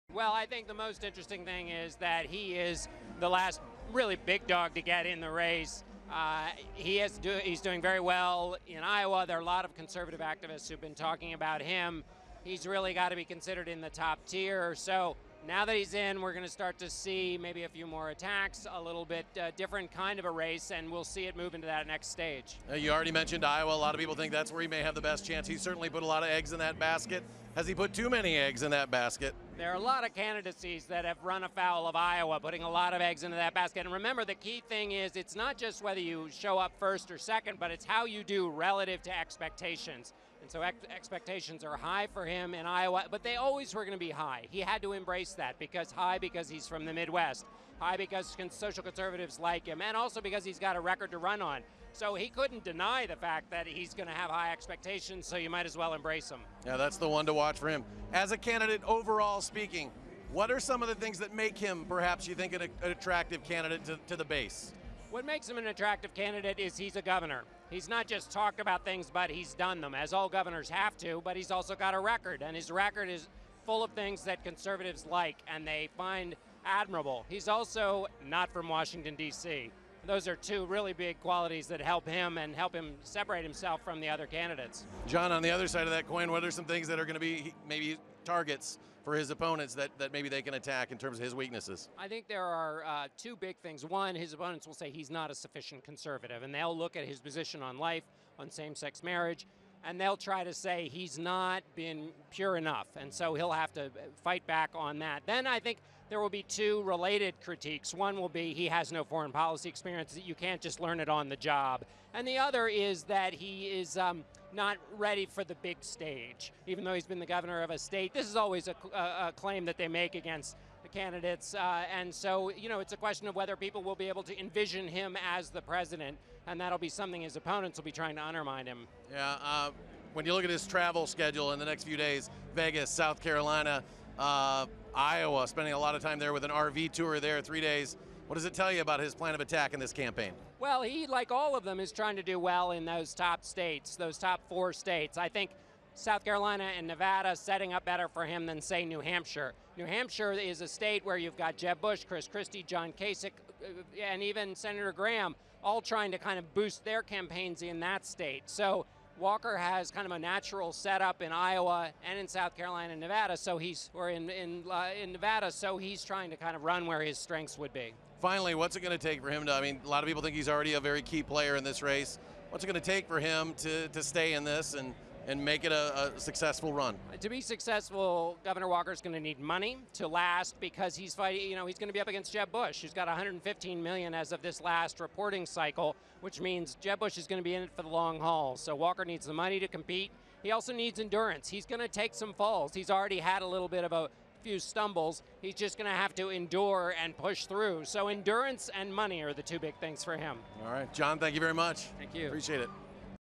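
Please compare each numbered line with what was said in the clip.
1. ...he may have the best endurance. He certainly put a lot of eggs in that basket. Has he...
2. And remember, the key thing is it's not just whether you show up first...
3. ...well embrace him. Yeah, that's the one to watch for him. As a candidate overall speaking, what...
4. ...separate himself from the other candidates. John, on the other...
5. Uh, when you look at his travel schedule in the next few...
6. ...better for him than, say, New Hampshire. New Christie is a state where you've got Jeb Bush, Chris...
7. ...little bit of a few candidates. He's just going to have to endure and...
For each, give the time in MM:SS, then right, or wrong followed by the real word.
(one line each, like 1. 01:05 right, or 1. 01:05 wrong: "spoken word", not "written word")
1. 00:24 wrong: "chance", not "endurance"
2. 00:33 right
3. 00:55 right
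4. 01:23 right
5. 02:09 right
6. 02:27 wrong: "Hampshire", not "Christie"
7. 03:13 wrong: "stumbles", not "candidates".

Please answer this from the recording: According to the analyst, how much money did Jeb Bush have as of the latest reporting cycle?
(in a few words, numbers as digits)
115 million.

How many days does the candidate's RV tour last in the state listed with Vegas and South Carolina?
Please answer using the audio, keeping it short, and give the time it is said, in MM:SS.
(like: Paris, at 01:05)
3, at 02:17.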